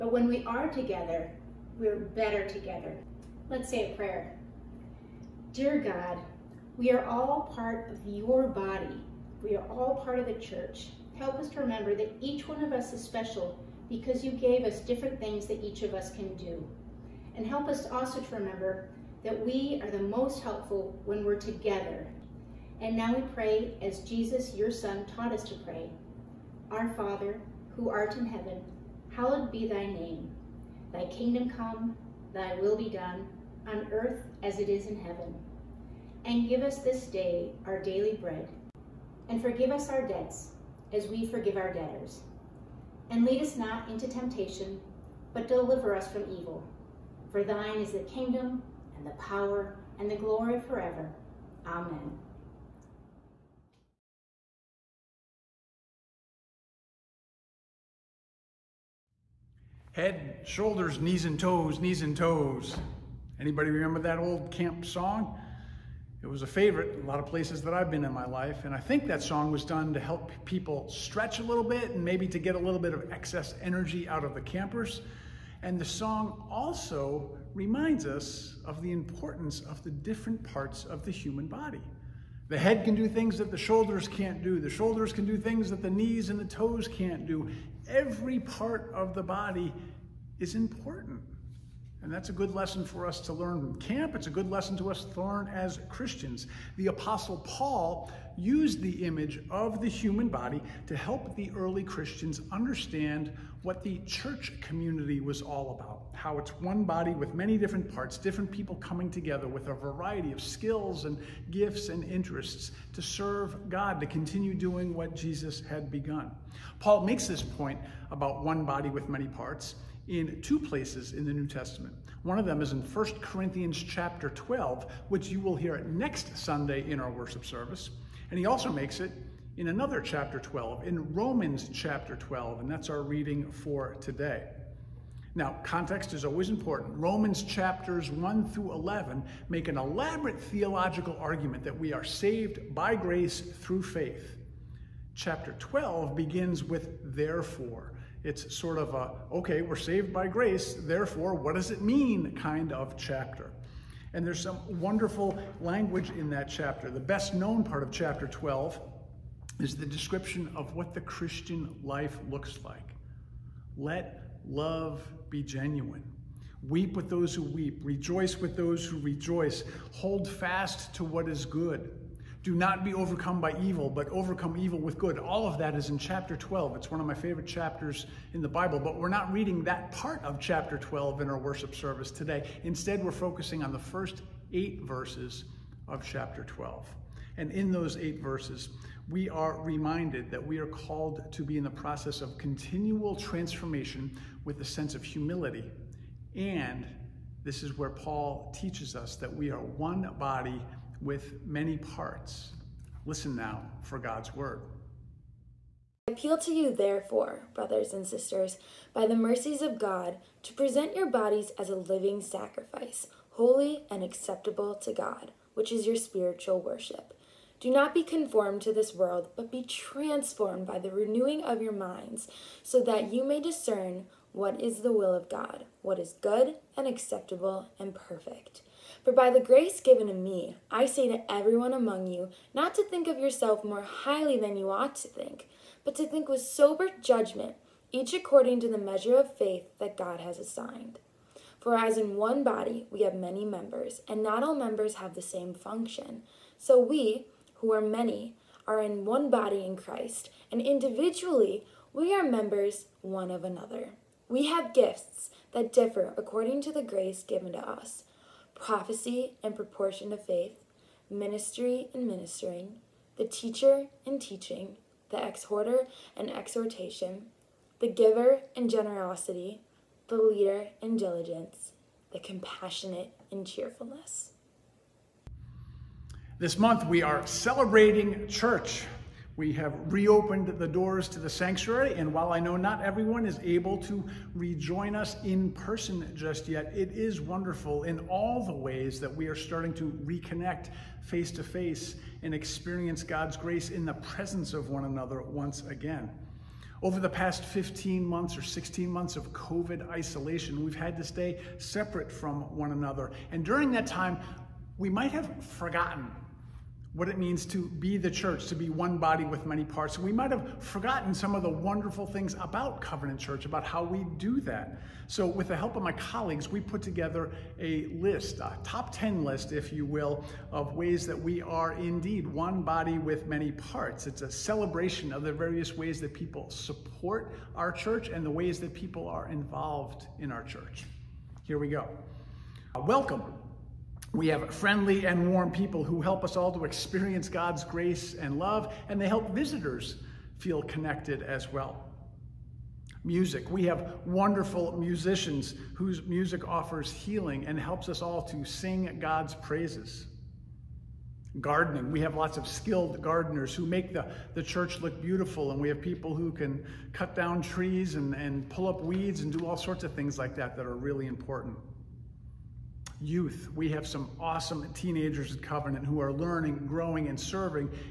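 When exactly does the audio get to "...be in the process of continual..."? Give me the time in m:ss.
3:11.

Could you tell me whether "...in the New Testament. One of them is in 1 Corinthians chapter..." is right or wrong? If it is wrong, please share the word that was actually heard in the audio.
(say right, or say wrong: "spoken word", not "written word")
right.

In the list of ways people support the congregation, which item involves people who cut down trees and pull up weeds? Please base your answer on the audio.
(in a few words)
Gardening.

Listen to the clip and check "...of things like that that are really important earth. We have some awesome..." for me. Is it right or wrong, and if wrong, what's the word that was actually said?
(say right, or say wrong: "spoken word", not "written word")
wrong: "youth", not "earth".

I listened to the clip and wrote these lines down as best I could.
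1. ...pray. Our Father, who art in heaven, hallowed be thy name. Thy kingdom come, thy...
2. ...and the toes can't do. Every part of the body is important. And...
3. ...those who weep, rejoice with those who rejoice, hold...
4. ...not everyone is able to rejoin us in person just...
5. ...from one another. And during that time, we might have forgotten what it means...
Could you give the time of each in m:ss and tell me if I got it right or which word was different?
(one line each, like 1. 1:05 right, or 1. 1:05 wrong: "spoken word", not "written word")
1. 0:25 right
2. 1:26 right
3. 2:47 right
4. 4:42 right
5. 5:02 right.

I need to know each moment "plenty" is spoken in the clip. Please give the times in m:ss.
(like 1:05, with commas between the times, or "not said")
not said.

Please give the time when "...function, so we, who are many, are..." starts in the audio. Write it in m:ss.
4:05.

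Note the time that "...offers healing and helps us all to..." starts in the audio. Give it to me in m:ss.
5:46.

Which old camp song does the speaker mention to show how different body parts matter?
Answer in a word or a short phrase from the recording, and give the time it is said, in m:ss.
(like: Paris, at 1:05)
Head, shoulders, knees and toes, at 0:59.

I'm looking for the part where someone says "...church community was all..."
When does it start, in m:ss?
1:43.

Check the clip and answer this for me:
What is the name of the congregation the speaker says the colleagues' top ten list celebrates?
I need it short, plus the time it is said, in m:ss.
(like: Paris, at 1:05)
Covenant Church, at 5:12.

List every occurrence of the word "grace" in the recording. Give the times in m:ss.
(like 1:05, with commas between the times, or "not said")
2:22, 2:30, 3:49, 4:16, 4:53, 5:37.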